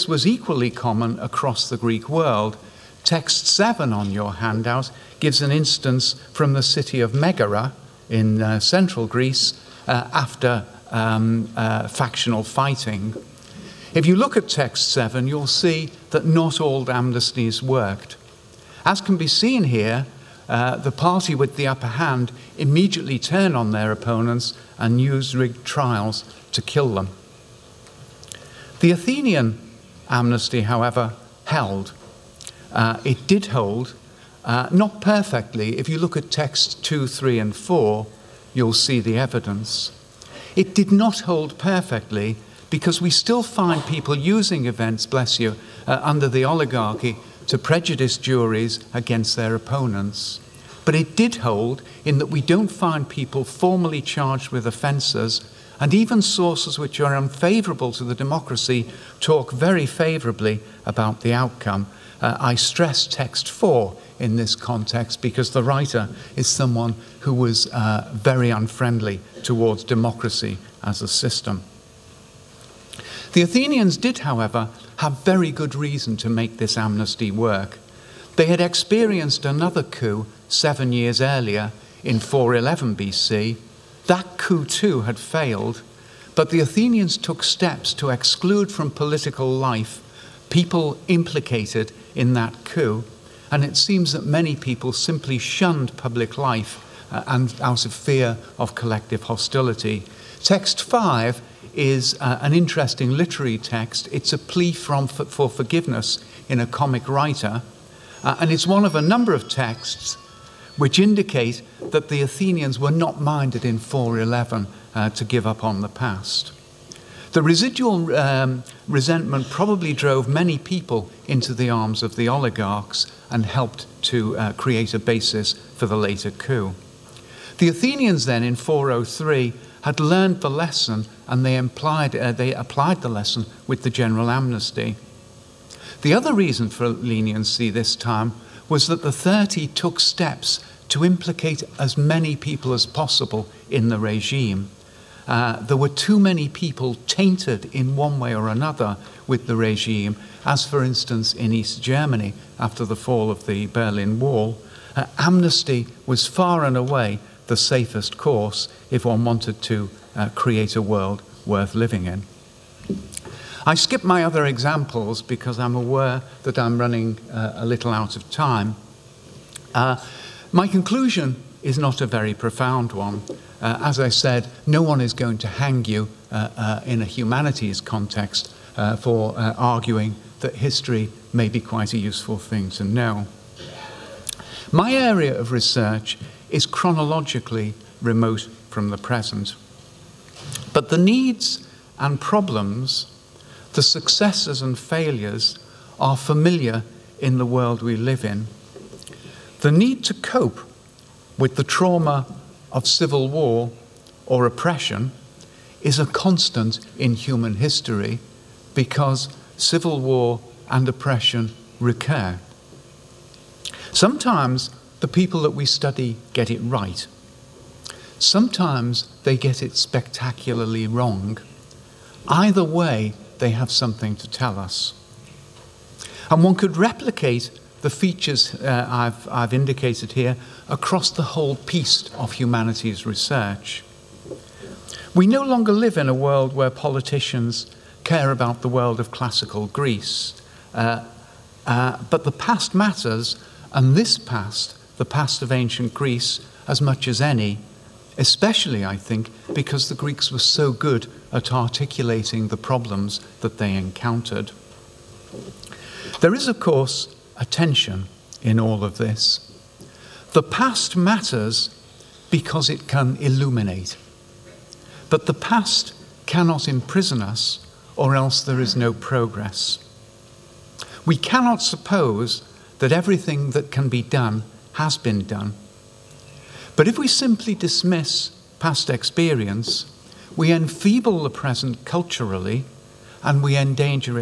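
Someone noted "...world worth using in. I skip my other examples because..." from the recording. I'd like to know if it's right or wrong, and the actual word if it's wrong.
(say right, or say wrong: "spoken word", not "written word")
wrong: "living", not "using".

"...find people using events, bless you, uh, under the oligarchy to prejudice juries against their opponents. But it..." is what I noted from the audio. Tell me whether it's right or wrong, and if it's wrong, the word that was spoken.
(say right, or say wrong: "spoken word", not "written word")
right.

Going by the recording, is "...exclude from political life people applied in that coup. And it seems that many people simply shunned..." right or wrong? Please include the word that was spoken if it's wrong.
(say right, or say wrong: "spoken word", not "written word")
wrong: "implicated", not "applied".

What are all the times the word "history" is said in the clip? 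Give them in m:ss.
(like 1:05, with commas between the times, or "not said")
3:00, 3:27.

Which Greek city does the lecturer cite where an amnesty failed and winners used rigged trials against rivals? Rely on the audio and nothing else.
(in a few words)
Megara.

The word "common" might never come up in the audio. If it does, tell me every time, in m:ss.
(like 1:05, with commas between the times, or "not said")
0:00.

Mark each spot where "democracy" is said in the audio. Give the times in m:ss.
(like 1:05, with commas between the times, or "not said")
0:58, 1:09.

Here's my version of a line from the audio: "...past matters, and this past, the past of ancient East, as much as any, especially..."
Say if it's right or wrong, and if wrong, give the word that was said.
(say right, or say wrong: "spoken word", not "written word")
wrong: "Greece", not "East".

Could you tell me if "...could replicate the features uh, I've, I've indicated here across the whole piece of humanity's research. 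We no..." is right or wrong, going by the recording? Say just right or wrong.
right.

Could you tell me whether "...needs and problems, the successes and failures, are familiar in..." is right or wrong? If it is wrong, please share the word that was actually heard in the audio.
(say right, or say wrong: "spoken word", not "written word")
right.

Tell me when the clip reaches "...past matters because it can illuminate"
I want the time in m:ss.
4:20.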